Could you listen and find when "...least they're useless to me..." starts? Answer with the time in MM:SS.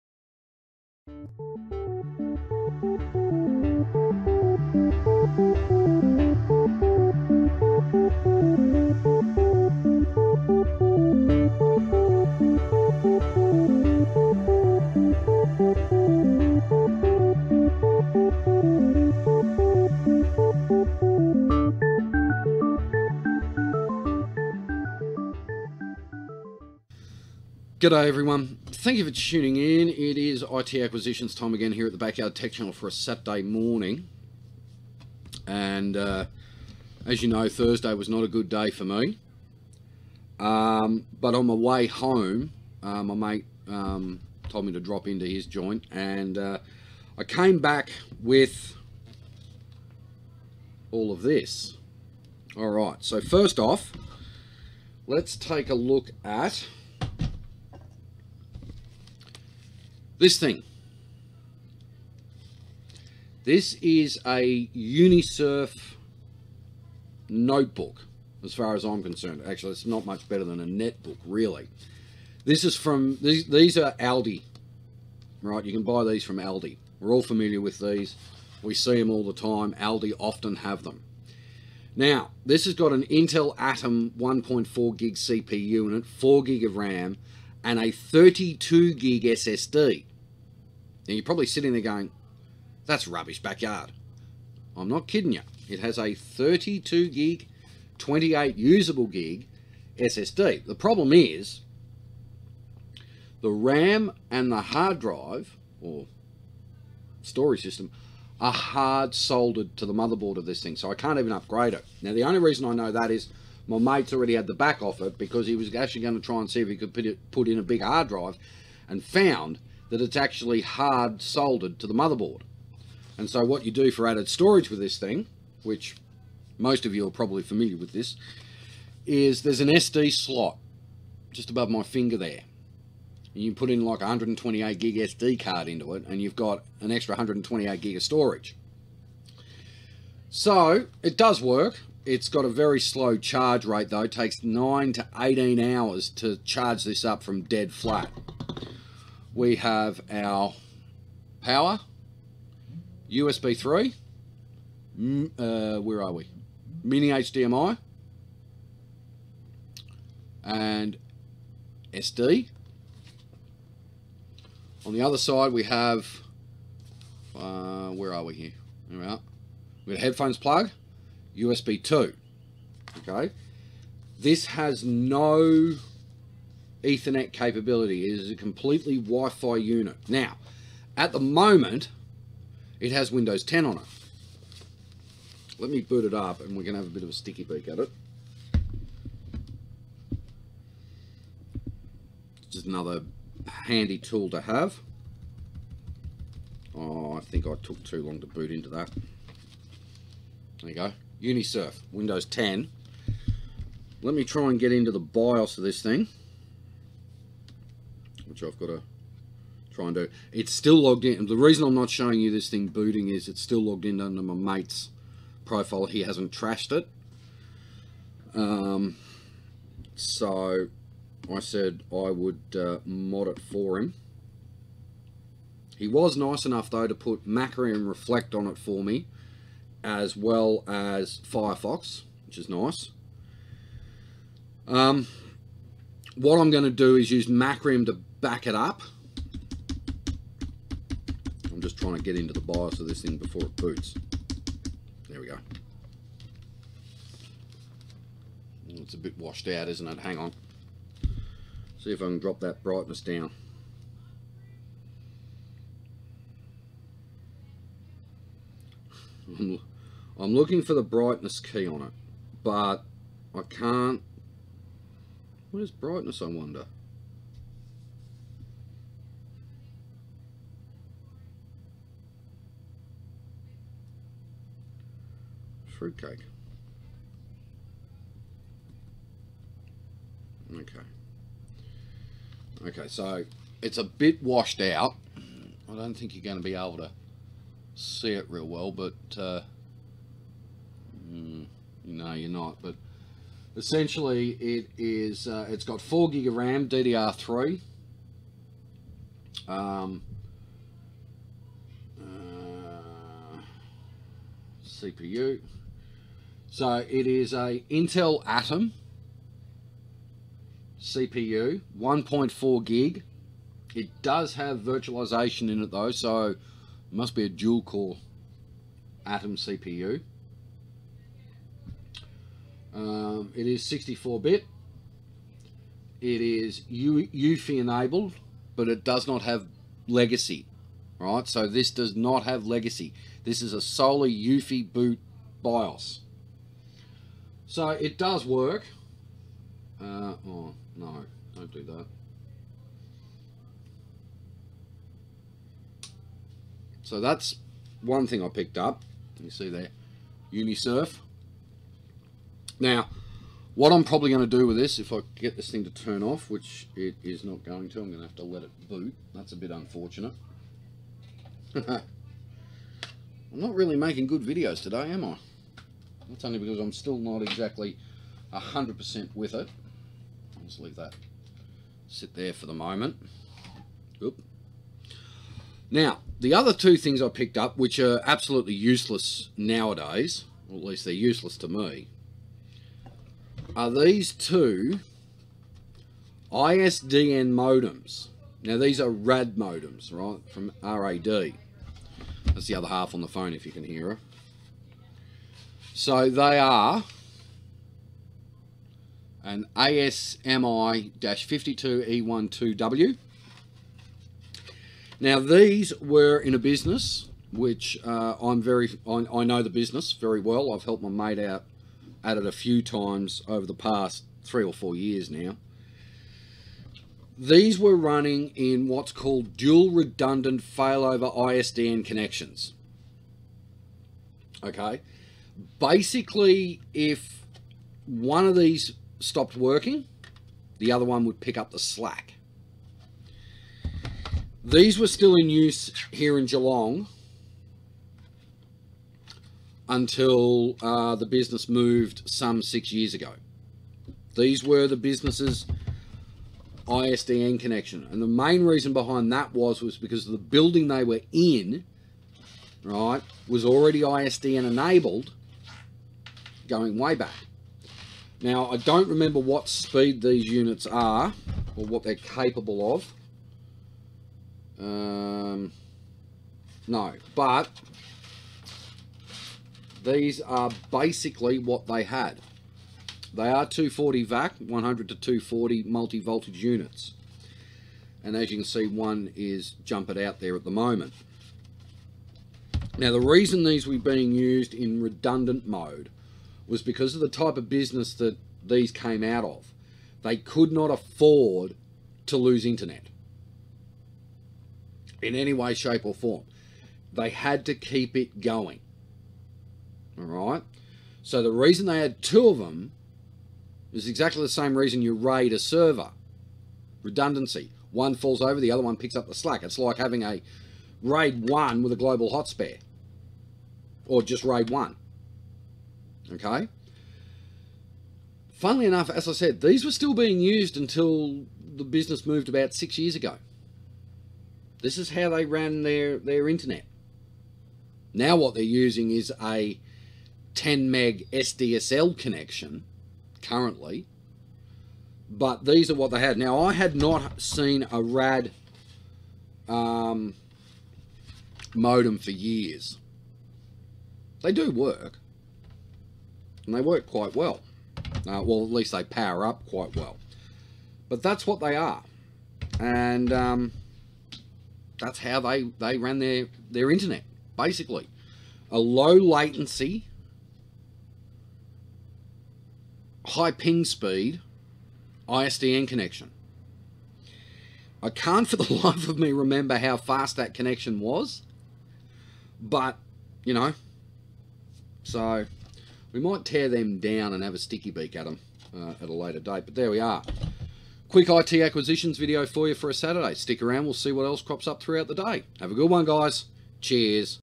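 06:20.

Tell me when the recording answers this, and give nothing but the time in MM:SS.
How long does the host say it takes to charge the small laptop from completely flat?
02:24.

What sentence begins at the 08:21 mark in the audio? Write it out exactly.
So the reason they had two of them is exactly the same reason you raid a server redundancy.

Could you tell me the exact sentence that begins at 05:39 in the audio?
Uh, oh, no, don't do that.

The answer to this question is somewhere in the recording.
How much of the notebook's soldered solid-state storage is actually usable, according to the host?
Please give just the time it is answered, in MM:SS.
01:37.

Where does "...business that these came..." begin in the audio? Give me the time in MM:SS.
08:07.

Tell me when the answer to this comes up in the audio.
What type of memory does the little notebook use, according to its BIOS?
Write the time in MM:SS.
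04:56.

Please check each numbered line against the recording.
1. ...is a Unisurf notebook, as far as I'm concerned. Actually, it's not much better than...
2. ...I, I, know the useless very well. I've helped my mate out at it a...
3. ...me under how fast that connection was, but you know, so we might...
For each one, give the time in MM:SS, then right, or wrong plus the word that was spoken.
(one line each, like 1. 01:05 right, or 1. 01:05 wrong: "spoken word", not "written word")
1. 01:03 right
2. 06:48 wrong: "business", not "useless"
3. 09:28 wrong: "remember", not "under".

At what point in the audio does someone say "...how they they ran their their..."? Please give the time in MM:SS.
09:14.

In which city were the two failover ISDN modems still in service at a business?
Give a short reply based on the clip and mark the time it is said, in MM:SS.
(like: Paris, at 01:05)
Geelong, at 07:16.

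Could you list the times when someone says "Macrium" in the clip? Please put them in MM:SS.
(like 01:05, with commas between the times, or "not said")
03:47, 03:57.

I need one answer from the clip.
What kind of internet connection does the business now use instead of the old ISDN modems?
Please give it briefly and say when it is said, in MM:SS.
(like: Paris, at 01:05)
10 meg SDSL, at 08:50.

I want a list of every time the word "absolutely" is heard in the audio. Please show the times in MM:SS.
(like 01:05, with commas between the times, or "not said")
06:18.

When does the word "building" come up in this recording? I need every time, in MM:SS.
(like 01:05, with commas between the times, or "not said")
07:30.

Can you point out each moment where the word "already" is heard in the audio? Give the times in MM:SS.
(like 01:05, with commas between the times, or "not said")
01:54, 07:33.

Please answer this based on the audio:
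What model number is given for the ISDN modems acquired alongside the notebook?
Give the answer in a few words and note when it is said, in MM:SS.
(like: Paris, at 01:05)
ASMI-52E12W, at 06:39.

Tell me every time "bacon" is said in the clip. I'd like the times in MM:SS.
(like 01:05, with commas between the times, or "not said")
not said.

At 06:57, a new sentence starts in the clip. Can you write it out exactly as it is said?
These were running in what's called dual redundant failover ISDN connections.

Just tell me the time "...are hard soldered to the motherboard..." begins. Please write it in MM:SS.
01:48.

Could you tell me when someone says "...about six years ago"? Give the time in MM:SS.
08:42.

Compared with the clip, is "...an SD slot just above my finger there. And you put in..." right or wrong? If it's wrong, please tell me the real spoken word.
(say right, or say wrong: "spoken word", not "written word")
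right.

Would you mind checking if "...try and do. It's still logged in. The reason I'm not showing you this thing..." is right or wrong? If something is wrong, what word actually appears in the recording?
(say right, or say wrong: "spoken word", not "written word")
right.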